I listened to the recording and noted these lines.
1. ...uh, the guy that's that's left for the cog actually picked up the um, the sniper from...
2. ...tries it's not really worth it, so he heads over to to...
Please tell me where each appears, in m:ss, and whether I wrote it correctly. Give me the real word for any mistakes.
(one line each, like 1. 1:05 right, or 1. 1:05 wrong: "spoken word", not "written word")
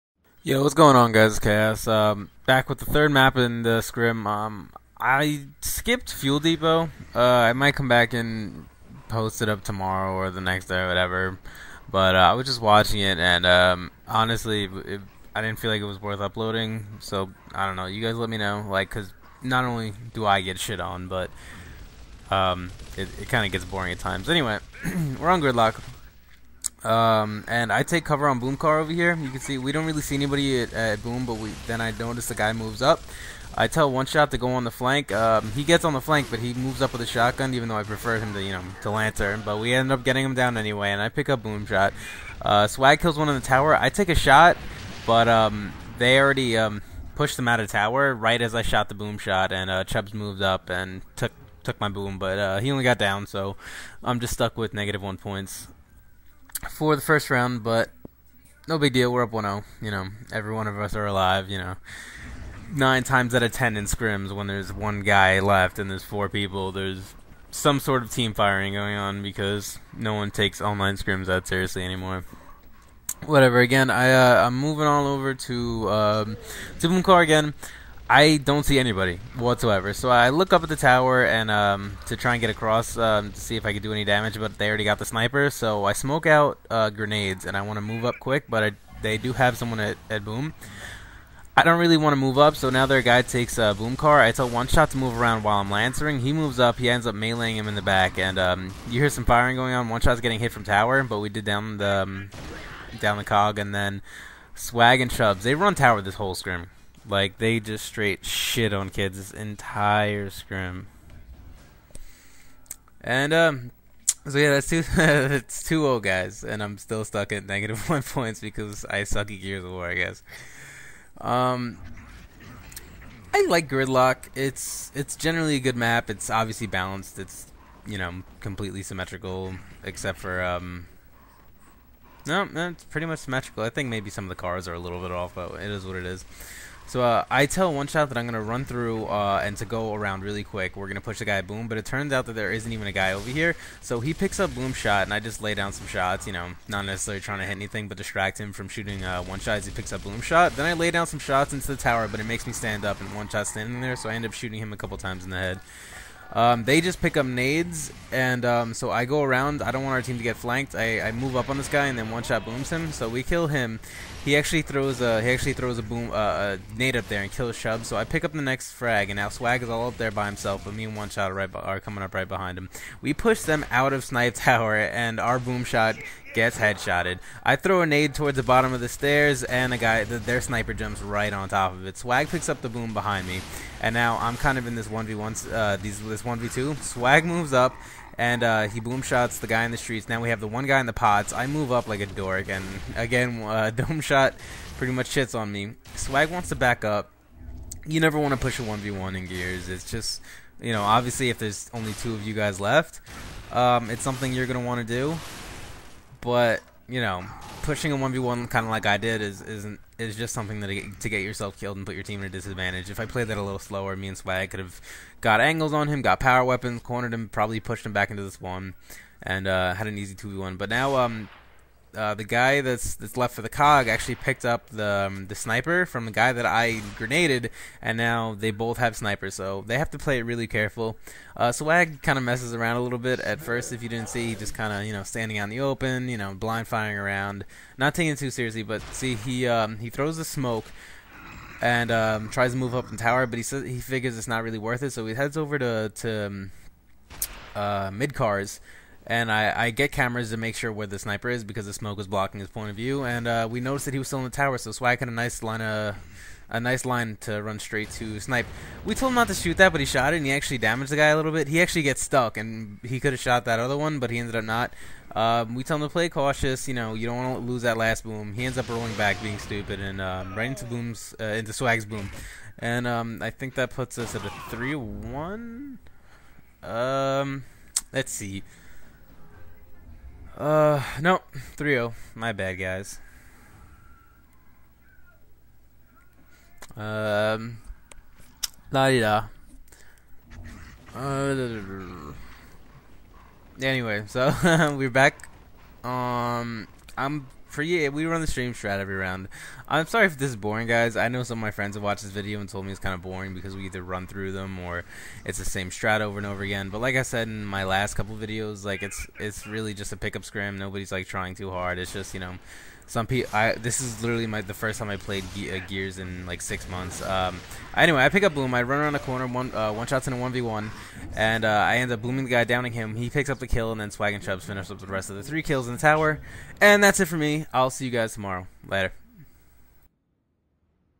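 1. 3:41 right
2. 4:03 wrong: "figures", not "tries".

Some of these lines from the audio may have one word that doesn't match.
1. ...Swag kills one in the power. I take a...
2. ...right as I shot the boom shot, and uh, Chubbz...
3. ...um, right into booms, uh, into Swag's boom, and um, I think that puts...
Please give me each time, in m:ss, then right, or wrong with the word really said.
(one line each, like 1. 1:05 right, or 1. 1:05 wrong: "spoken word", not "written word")
1. 0:42 wrong: "tower", not "power"
2. 0:48 right
3. 4:30 right.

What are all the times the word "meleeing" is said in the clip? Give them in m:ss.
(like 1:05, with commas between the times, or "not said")
1:37.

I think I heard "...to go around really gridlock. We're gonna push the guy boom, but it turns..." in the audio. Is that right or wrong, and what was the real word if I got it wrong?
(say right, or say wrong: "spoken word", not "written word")
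wrong: "quick", not "gridlock".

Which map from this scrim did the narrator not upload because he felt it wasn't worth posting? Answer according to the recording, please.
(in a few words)
Fuel Depot.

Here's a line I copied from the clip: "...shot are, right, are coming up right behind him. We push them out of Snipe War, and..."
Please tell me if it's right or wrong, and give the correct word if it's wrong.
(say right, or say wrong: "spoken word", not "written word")
wrong: "Tower", not "War".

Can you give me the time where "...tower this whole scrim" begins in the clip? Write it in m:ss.
1:45.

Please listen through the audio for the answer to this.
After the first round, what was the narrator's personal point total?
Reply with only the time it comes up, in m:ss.
0:54.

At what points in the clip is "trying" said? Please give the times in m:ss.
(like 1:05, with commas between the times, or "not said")
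2:27, 5:11.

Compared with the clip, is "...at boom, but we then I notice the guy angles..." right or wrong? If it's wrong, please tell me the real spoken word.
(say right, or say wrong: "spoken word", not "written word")
wrong: "moves", not "angles".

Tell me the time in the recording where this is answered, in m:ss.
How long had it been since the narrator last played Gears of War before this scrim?
5:16.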